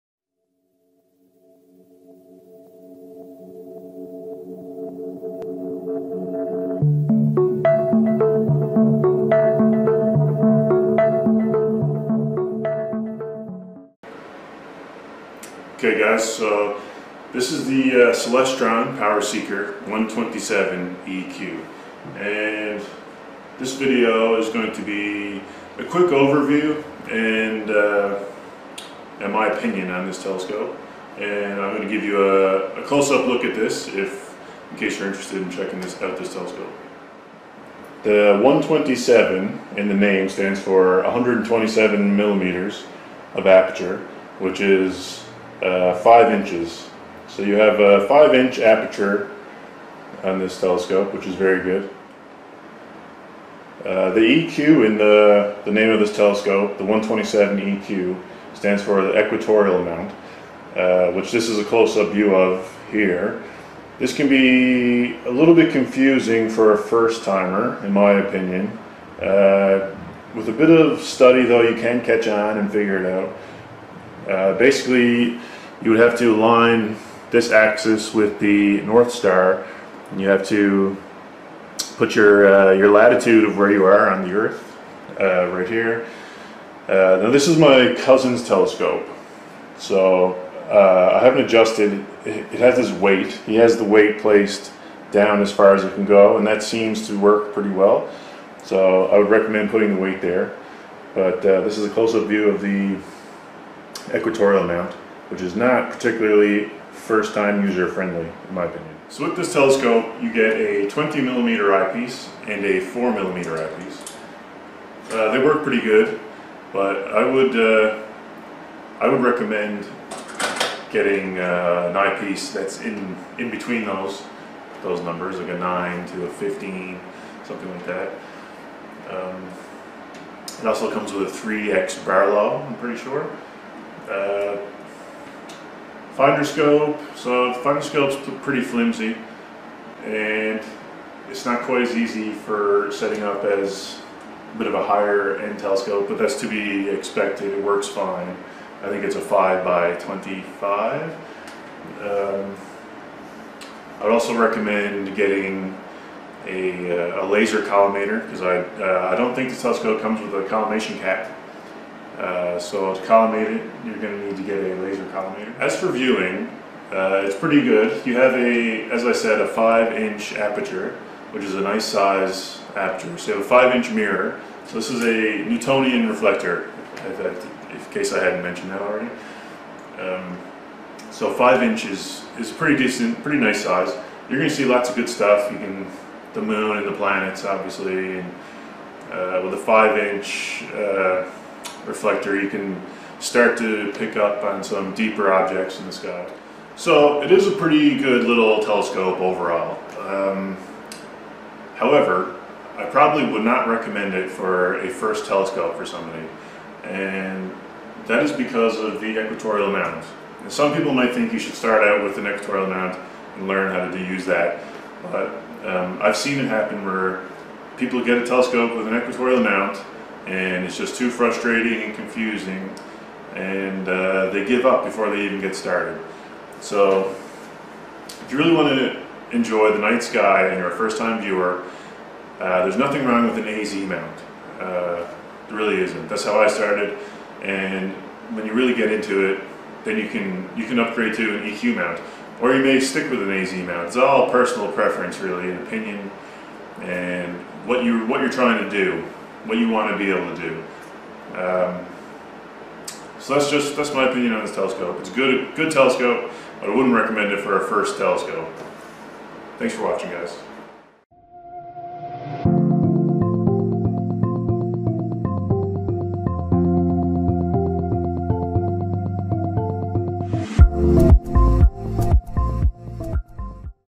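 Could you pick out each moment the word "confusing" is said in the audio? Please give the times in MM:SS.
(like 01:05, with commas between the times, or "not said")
01:05, 03:41.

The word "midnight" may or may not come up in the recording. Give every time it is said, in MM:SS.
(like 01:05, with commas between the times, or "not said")
not said.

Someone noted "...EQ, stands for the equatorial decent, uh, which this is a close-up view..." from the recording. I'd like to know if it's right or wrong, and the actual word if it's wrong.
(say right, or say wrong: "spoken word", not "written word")
wrong: "amount", not "decent".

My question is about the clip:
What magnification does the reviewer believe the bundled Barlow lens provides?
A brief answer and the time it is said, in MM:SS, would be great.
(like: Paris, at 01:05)
3x, at 02:11.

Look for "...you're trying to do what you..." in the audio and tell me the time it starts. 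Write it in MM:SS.
04:08.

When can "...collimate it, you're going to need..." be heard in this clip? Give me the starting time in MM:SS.
02:43.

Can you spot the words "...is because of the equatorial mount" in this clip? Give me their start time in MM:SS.
03:28.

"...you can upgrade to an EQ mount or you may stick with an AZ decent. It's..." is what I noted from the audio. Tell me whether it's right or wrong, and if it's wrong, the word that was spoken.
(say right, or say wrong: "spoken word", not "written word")
wrong: "mount", not "decent".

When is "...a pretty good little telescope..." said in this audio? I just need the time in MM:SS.
03:17.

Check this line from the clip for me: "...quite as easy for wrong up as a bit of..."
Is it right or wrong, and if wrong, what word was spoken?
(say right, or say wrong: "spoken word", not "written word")
wrong: "setting", not "wrong".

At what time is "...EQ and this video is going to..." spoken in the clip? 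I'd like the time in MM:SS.
00:21.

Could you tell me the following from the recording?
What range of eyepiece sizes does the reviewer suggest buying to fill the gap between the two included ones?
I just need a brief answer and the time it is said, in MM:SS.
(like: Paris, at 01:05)
9 to 15, at 02:05.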